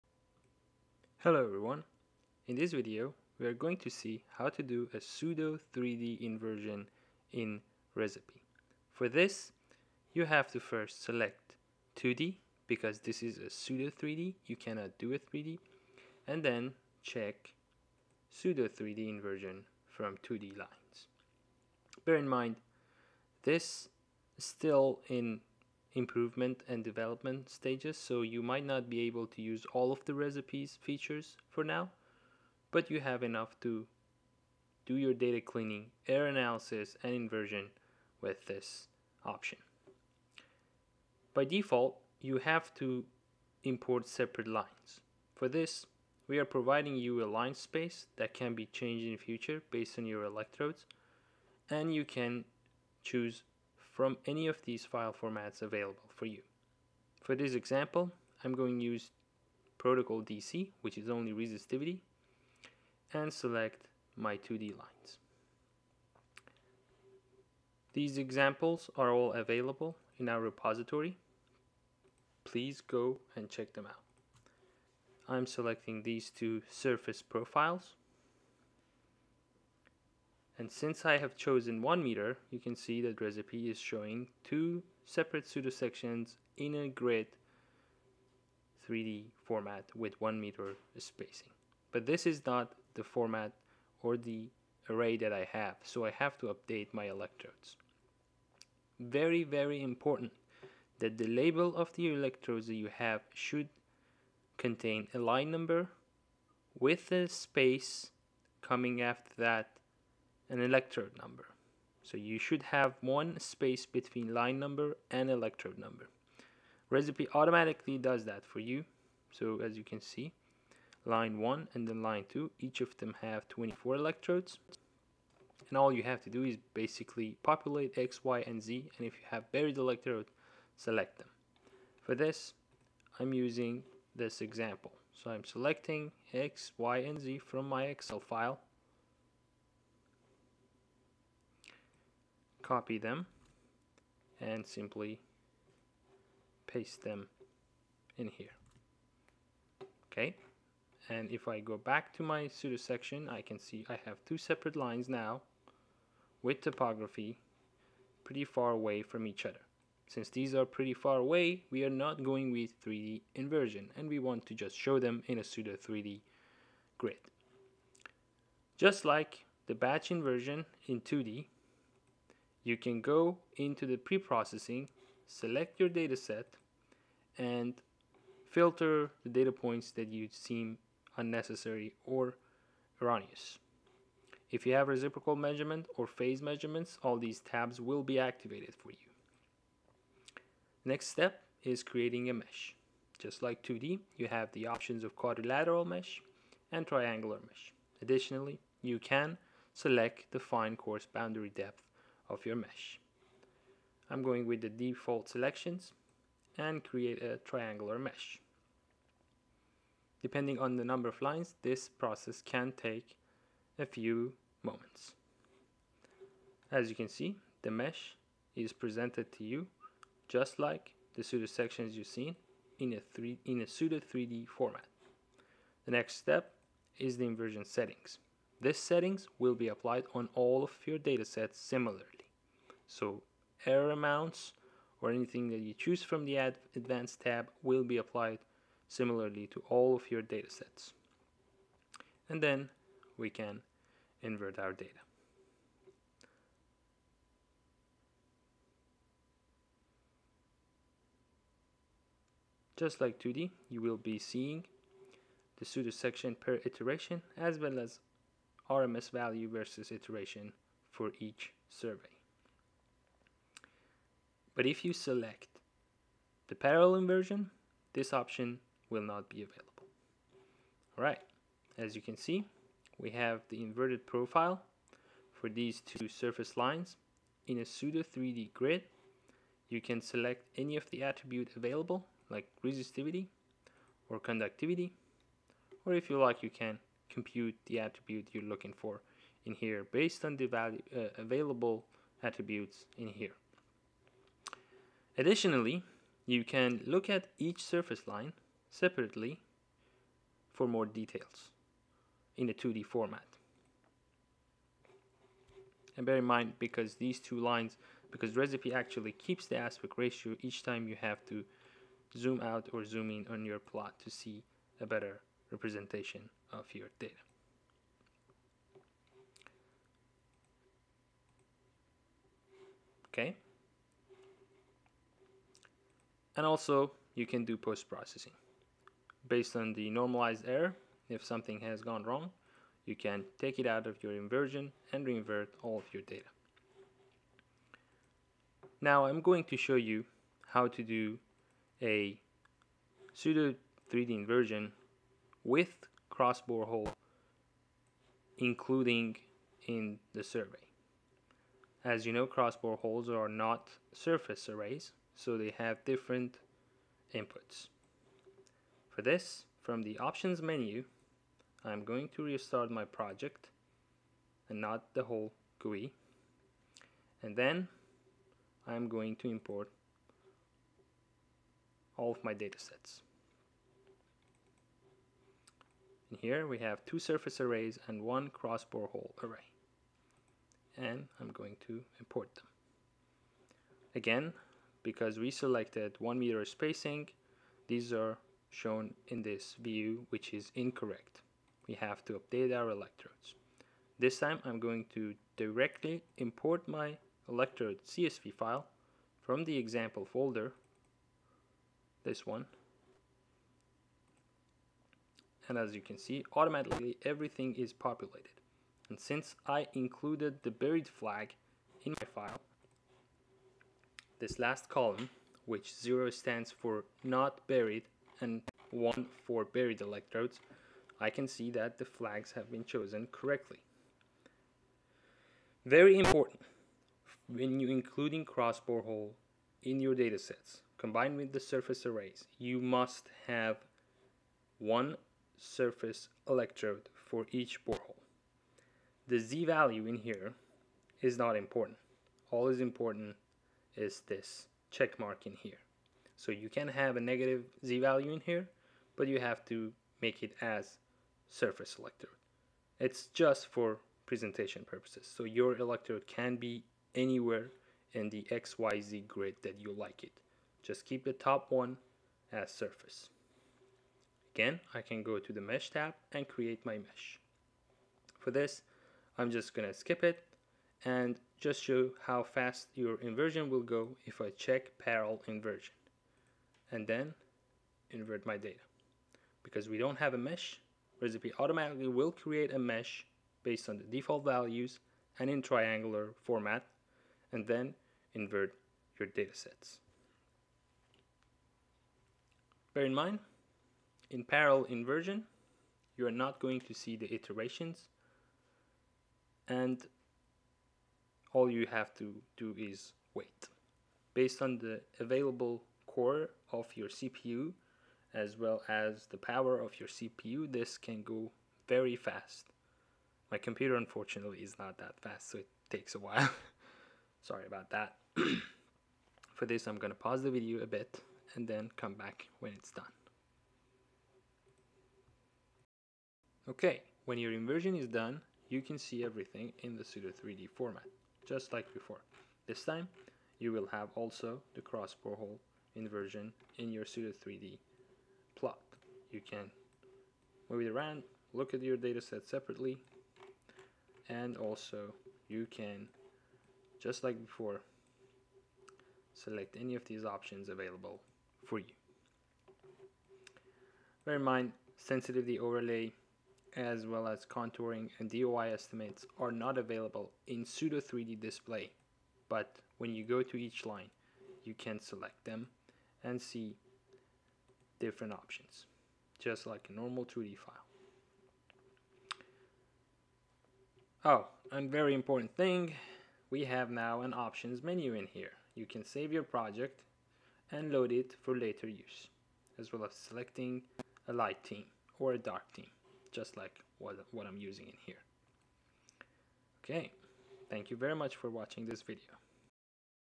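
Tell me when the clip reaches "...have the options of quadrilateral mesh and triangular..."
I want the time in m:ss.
3:14.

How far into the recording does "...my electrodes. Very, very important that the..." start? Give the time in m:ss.
1:36.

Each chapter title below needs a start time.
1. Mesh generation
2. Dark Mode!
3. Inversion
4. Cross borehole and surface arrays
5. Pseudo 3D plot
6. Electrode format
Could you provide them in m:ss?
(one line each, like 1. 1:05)
1. 3:10
2. 9:32
3. 3:45
4. 5:37
5. 4:30
6. 1:31.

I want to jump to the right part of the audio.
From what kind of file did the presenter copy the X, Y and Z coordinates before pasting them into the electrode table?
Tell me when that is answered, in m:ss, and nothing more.
2:17.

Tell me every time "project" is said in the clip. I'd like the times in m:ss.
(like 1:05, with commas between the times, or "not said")
6:02, 9:39.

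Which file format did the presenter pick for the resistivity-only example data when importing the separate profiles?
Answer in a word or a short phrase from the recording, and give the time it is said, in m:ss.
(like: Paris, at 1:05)
Protocol DC, at 0:59.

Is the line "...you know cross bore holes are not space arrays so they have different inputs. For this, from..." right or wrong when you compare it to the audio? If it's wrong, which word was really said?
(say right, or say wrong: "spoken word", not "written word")
wrong: "surface", not "space".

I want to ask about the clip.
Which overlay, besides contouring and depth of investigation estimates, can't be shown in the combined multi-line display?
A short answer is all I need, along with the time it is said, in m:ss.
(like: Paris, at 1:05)
Sensitivity overlay, at 9:14.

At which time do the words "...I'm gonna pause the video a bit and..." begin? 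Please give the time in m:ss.
8:39.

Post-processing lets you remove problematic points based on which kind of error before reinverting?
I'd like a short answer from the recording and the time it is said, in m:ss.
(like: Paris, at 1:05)
Normalized error, at 5:29.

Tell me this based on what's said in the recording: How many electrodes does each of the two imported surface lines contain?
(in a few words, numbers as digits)
24.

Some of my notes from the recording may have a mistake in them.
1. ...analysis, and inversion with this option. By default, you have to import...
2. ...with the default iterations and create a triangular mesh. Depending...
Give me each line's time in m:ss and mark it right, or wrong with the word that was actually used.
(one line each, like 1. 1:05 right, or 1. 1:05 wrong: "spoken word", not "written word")
1. 0:36 right
2. 3:24 wrong: "selections", not "iterations".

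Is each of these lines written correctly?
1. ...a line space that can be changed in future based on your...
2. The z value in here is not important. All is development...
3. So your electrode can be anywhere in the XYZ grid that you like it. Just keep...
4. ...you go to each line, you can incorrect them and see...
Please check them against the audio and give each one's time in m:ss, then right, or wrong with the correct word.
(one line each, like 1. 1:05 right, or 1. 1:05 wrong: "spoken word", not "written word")
1. 0:47 right
2. 7:19 wrong: "important", not "development"
3. 7:35 right
4. 9:22 wrong: "select", not "incorrect".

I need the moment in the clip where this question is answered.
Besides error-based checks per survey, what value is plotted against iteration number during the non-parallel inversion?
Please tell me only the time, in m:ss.
4:18.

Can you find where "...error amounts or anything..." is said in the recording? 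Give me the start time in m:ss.
3:53.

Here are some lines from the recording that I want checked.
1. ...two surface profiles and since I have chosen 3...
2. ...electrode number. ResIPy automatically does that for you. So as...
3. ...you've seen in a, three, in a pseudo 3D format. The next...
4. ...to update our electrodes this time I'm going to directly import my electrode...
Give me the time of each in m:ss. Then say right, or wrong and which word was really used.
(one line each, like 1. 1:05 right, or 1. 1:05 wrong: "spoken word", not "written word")
1. 1:16 wrong: "1", not "3"
2. 1:55 right
3. 3:41 right
4. 6:32 right.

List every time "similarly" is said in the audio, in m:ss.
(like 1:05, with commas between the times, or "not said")
3:51, 3:58.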